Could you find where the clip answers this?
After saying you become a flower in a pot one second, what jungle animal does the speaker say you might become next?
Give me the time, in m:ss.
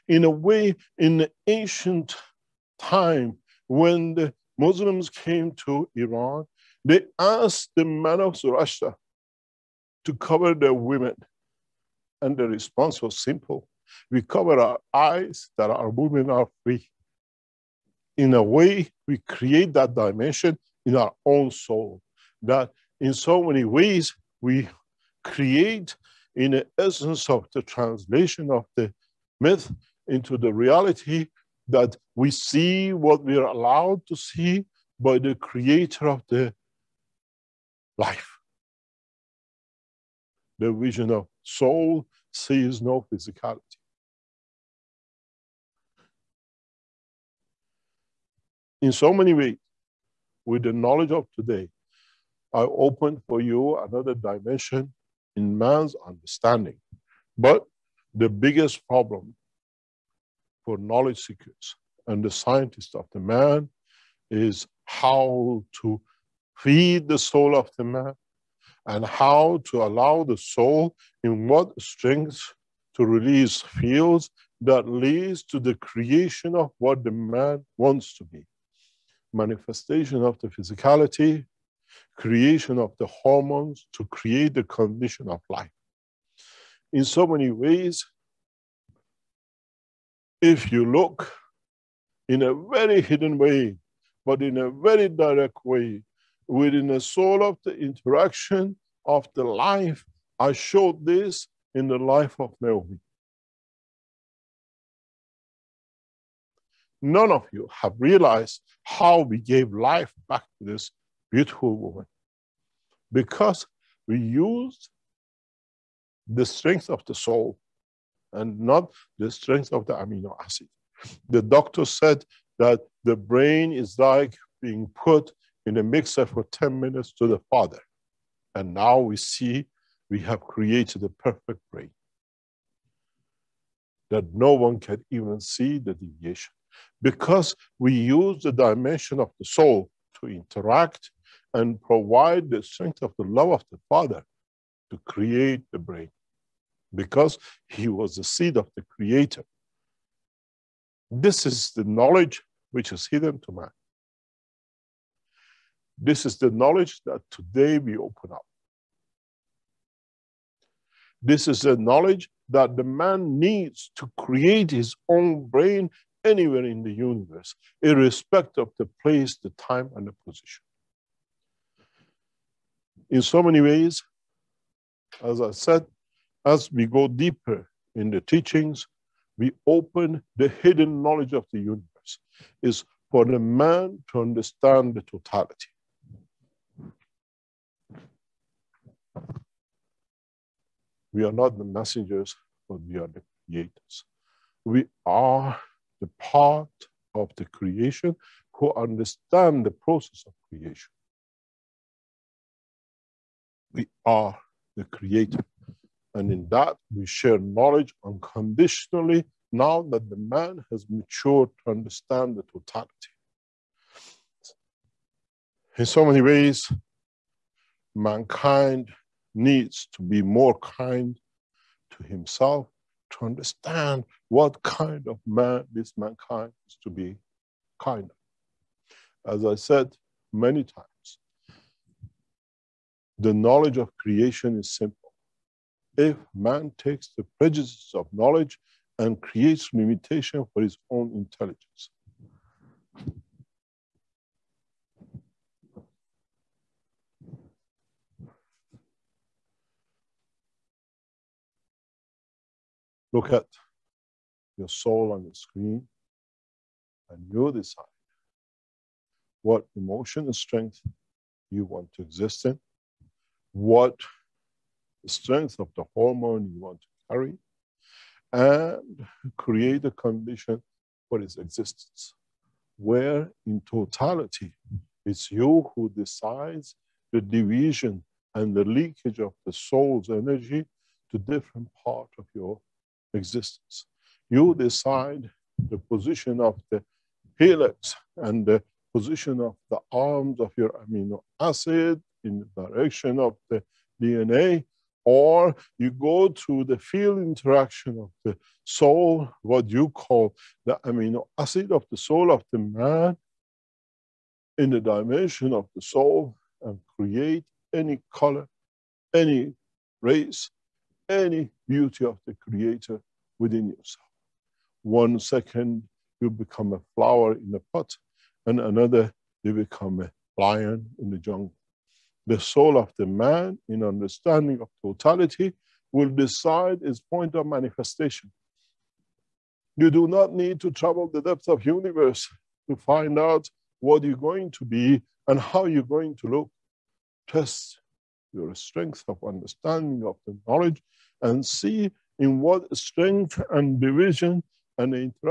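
5:20.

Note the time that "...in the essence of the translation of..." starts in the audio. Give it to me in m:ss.
0:26.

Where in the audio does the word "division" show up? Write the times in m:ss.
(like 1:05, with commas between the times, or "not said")
4:37, 5:43.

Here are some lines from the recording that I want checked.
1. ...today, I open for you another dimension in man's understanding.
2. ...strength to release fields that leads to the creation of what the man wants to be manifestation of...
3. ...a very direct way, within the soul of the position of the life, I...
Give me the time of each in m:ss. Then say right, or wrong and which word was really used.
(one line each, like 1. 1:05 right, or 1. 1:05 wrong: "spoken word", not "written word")
1. 0:51 right
2. 1:11 right
3. 1:34 wrong: "interaction", not "position".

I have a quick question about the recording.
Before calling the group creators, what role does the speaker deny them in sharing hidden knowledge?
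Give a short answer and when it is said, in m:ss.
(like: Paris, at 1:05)
Messengers, at 3:11.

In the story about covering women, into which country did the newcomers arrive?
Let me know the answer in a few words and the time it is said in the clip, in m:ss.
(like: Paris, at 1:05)
Iran, at 0:05.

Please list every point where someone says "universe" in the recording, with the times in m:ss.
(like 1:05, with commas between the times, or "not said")
2:46, 3:01, 5:31.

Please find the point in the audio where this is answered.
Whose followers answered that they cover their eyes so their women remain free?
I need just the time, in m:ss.
0:08.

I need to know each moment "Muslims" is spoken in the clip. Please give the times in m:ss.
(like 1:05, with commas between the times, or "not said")
0:04.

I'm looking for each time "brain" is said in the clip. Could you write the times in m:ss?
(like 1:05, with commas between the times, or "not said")
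2:03, 2:11, 2:25, 2:45.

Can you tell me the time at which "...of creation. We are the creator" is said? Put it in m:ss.
3:20.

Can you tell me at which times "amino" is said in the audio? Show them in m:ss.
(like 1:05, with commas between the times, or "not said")
1:59, 4:50, 5:00.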